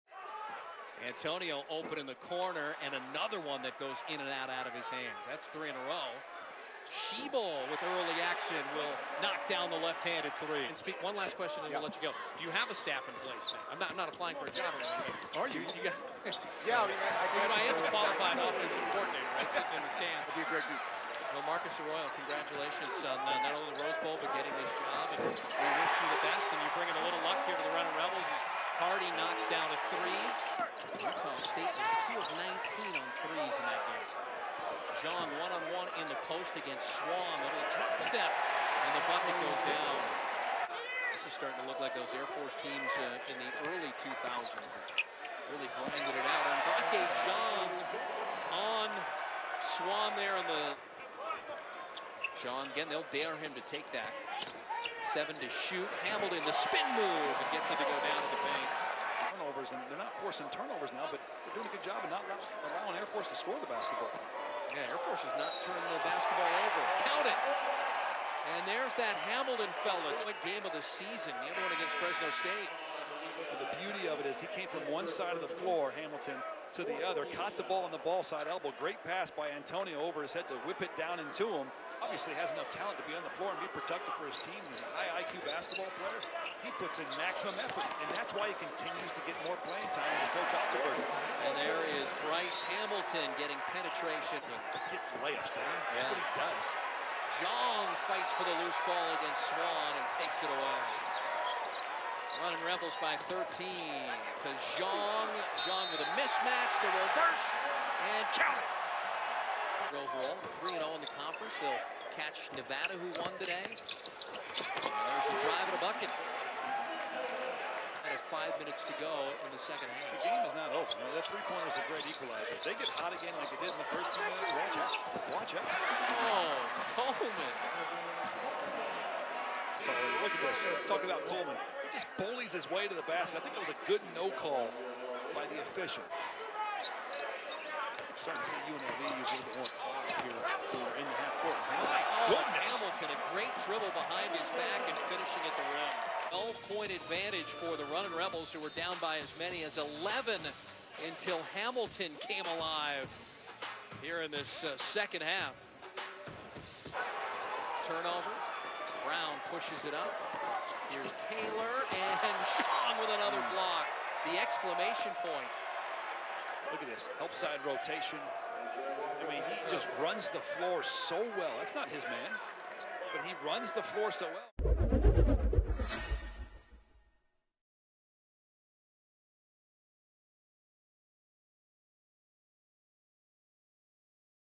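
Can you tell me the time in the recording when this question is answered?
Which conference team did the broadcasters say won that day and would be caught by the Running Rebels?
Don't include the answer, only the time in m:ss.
1:52.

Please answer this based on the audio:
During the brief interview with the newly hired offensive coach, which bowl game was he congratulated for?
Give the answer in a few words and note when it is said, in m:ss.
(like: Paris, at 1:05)
Rose Bowl, at 0:23.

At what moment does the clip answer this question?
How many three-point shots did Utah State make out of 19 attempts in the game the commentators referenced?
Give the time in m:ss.
0:32.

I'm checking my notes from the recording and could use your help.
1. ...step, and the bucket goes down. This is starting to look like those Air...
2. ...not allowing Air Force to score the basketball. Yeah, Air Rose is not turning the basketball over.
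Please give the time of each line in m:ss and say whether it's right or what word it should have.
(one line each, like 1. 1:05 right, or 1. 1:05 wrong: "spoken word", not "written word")
1. 0:38 right
2. 1:02 wrong: "Force", not "Rose".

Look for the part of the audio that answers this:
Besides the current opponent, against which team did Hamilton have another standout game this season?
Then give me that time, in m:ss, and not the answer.
1:11.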